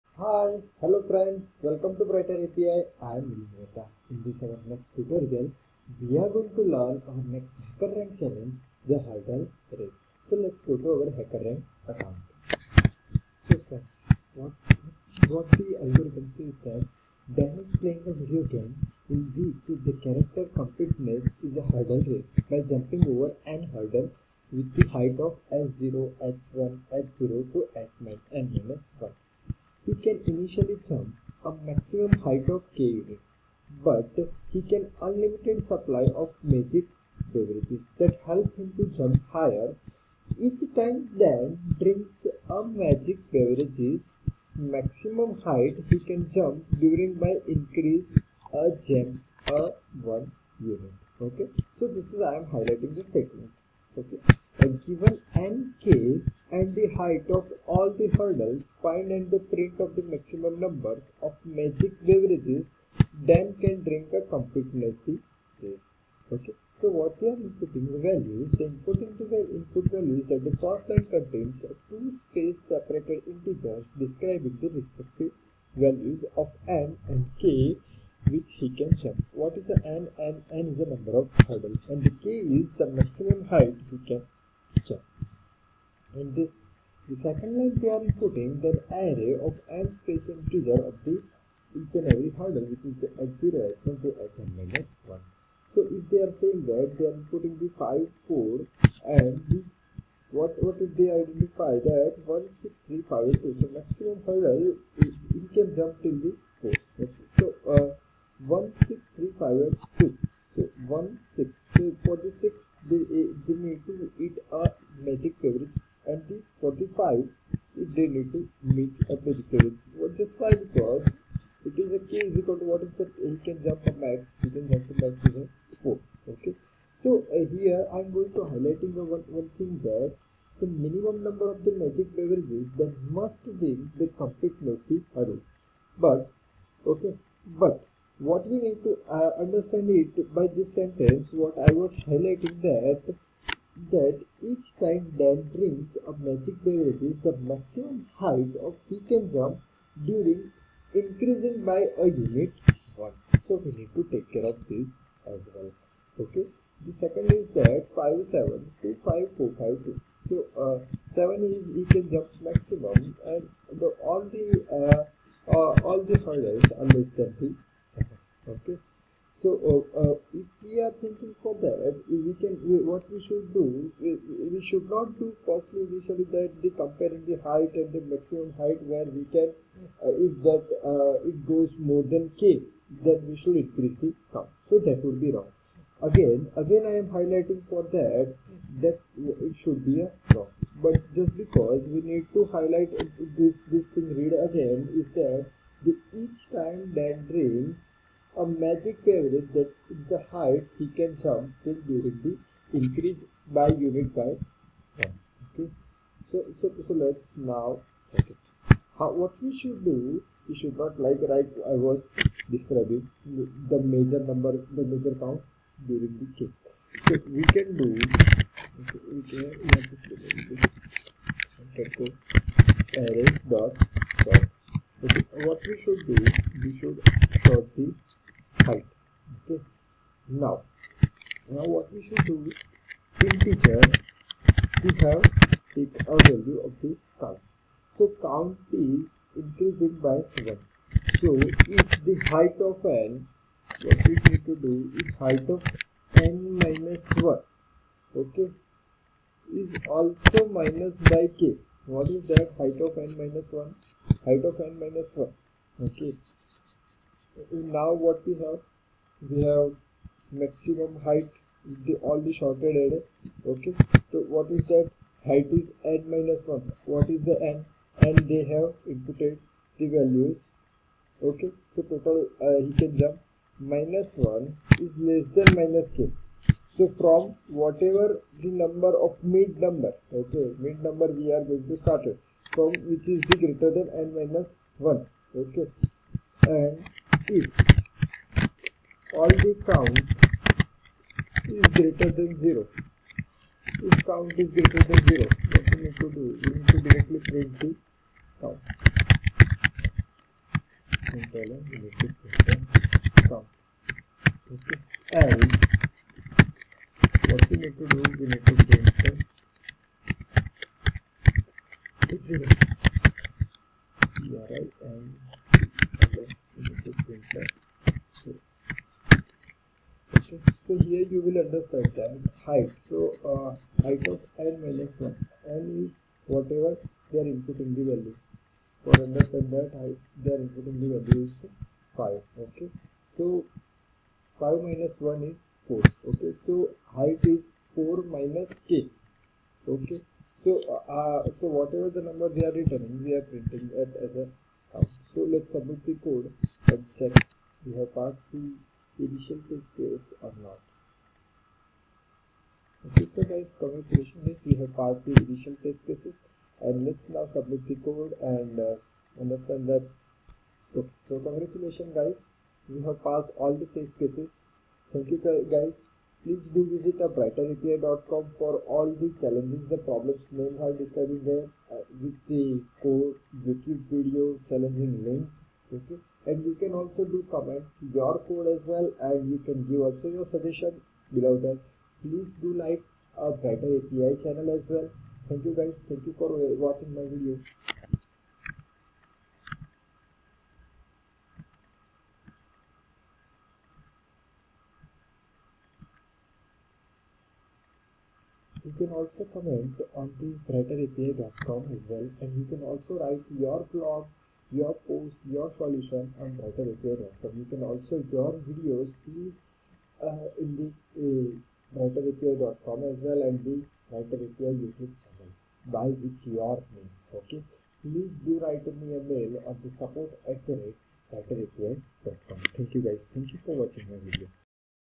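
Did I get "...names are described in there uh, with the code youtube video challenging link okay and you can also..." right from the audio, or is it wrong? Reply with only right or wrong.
right.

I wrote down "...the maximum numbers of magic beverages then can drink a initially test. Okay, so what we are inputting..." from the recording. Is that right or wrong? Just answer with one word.
wrong.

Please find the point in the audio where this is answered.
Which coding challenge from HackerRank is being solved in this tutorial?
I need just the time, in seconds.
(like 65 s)
8 s.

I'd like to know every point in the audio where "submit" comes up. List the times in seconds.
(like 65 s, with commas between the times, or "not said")
345 s, 357 s.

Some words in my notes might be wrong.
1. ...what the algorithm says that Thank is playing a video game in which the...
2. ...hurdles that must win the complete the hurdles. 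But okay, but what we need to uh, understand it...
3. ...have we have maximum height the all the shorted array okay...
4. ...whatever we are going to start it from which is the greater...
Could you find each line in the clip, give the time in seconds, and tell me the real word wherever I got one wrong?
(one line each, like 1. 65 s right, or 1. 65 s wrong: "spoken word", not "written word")
1. 15 s wrong: "Dan", not "Thank"
2. 132 s wrong: "beverages", not "hurdles"
3. 258 s right
4. 280 s wrong: "number", not "whatever".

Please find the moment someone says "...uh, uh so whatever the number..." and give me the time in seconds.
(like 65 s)
340 s.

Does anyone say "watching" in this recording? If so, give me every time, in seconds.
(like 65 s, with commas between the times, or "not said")
386 s, 423 s.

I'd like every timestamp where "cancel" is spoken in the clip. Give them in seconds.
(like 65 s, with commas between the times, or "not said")
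308 s.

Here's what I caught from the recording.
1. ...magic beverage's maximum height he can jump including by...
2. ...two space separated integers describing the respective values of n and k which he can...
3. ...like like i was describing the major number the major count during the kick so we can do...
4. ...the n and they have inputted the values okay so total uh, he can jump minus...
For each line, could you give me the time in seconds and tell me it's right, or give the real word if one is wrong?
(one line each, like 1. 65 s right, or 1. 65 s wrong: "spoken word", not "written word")
1. 42 s wrong: "during", not "including"
2. 71 s right
3. 211 s right
4. 267 s right.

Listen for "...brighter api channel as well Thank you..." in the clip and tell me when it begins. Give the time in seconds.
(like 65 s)
383 s.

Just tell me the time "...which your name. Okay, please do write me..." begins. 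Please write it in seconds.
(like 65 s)
416 s.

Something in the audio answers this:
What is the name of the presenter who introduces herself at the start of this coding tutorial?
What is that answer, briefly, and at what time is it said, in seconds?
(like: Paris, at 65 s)
Vinita, at 3 s.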